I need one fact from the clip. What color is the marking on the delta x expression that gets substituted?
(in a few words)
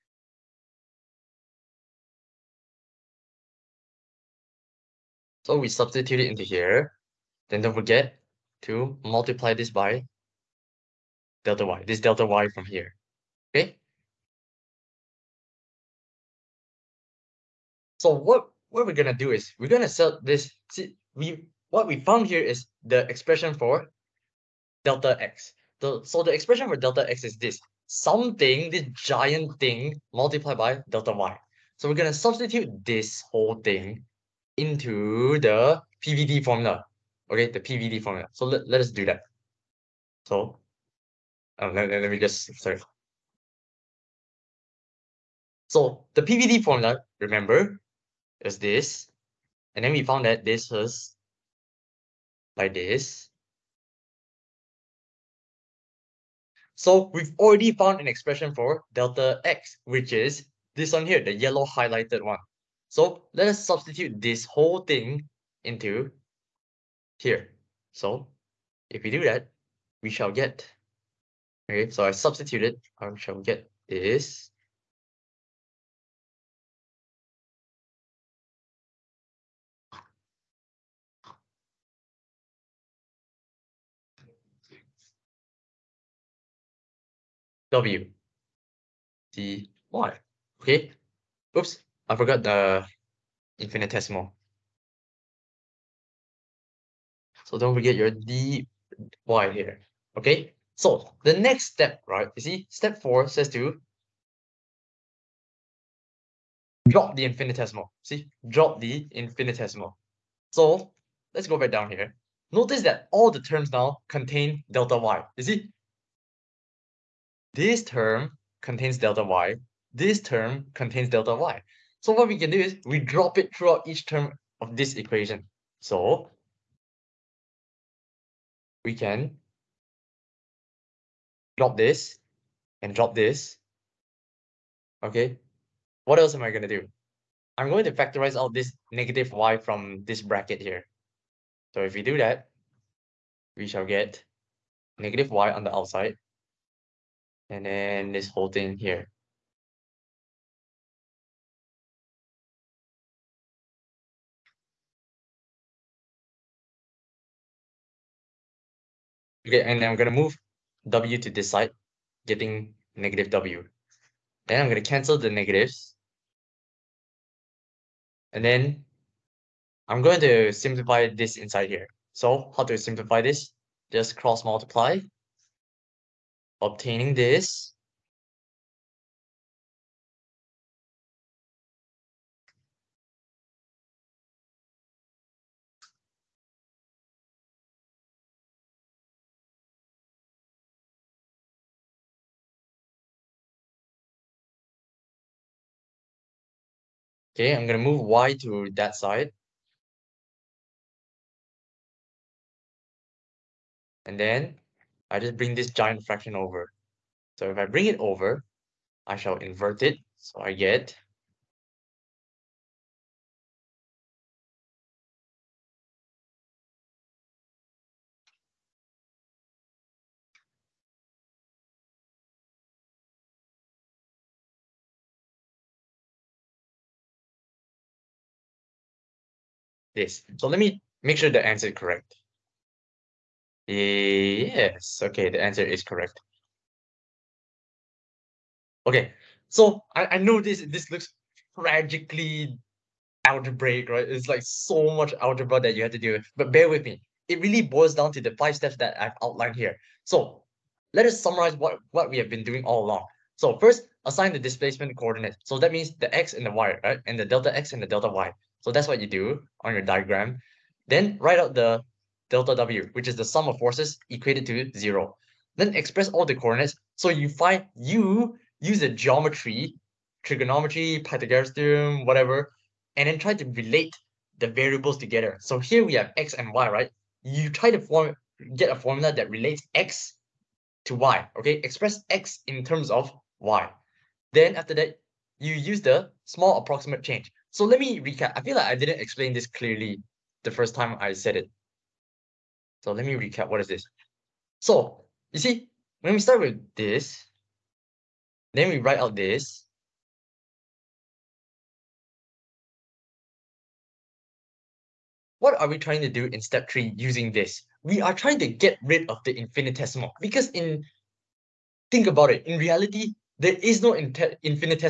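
yellow.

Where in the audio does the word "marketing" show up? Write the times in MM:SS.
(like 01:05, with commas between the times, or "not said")
not said.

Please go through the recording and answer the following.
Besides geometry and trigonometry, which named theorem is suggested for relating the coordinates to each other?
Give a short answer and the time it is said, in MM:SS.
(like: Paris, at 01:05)
Pythagoras theorem, at 04:31.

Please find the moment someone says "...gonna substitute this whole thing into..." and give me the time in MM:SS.
00:31.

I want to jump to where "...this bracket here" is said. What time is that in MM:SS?
02:20.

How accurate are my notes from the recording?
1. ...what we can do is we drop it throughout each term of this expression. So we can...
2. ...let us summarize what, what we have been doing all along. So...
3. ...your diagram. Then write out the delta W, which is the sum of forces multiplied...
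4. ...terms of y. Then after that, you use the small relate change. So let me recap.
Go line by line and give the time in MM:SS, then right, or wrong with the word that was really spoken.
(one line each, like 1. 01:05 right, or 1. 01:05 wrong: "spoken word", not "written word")
1. 02:02 wrong: "equation", not "expression"
2. 04:10 right
3. 04:19 wrong: "equated", not "multiplied"
4. 04:42 wrong: "approximate", not "relate".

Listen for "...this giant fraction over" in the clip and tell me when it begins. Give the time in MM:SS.
03:25.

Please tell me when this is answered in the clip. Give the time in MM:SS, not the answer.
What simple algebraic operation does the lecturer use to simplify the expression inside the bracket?
02:54.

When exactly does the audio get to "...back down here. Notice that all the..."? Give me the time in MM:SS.
01:51.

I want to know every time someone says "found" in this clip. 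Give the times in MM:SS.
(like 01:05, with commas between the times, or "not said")
00:22, 00:50, 00:57.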